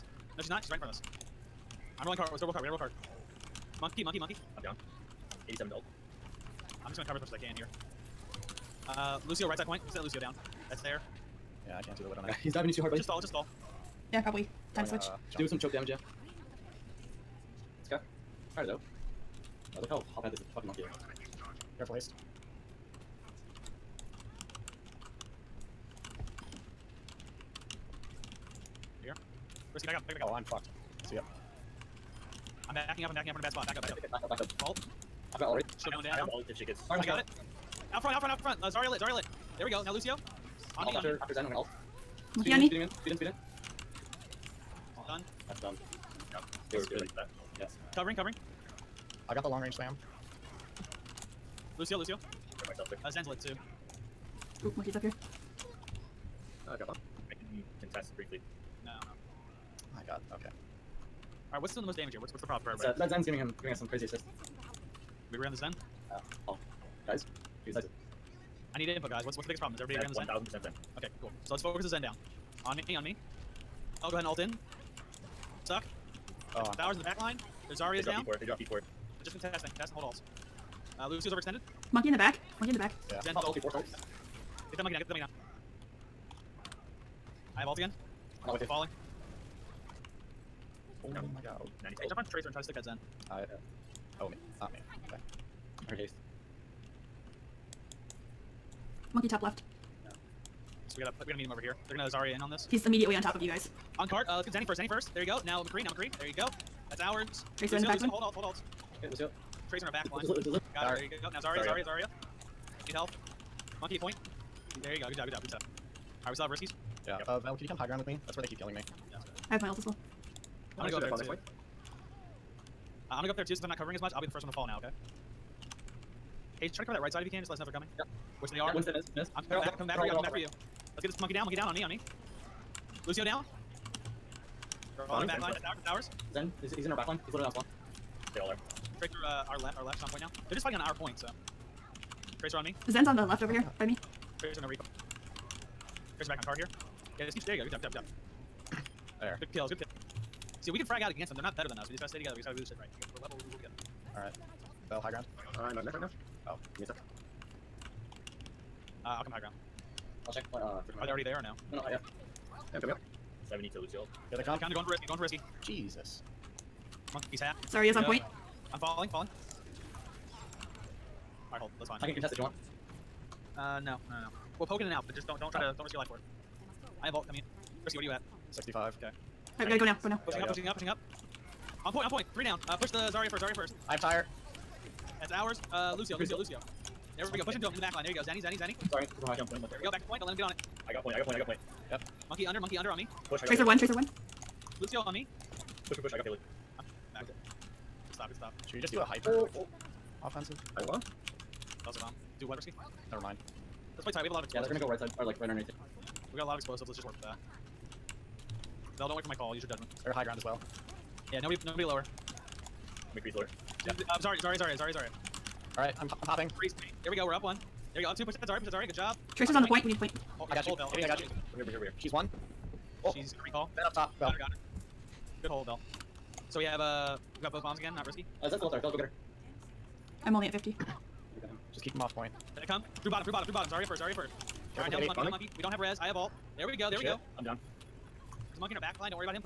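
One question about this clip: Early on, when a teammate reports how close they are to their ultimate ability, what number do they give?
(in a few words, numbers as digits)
87.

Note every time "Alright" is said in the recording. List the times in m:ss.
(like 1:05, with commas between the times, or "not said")
1:01, 1:56, 2:34, 2:51, 2:59.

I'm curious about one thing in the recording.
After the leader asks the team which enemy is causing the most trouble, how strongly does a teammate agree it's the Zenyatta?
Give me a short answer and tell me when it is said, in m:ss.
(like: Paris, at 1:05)
1000%, at 1:10.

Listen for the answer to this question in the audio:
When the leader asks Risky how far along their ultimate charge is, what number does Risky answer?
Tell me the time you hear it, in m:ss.
2:58.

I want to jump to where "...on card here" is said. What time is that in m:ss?
2:26.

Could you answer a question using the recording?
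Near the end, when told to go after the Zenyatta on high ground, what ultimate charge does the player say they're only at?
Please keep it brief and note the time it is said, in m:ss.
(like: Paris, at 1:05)
50, at 3:50.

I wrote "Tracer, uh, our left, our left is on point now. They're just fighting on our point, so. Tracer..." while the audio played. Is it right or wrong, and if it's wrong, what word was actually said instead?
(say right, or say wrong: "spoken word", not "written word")
right.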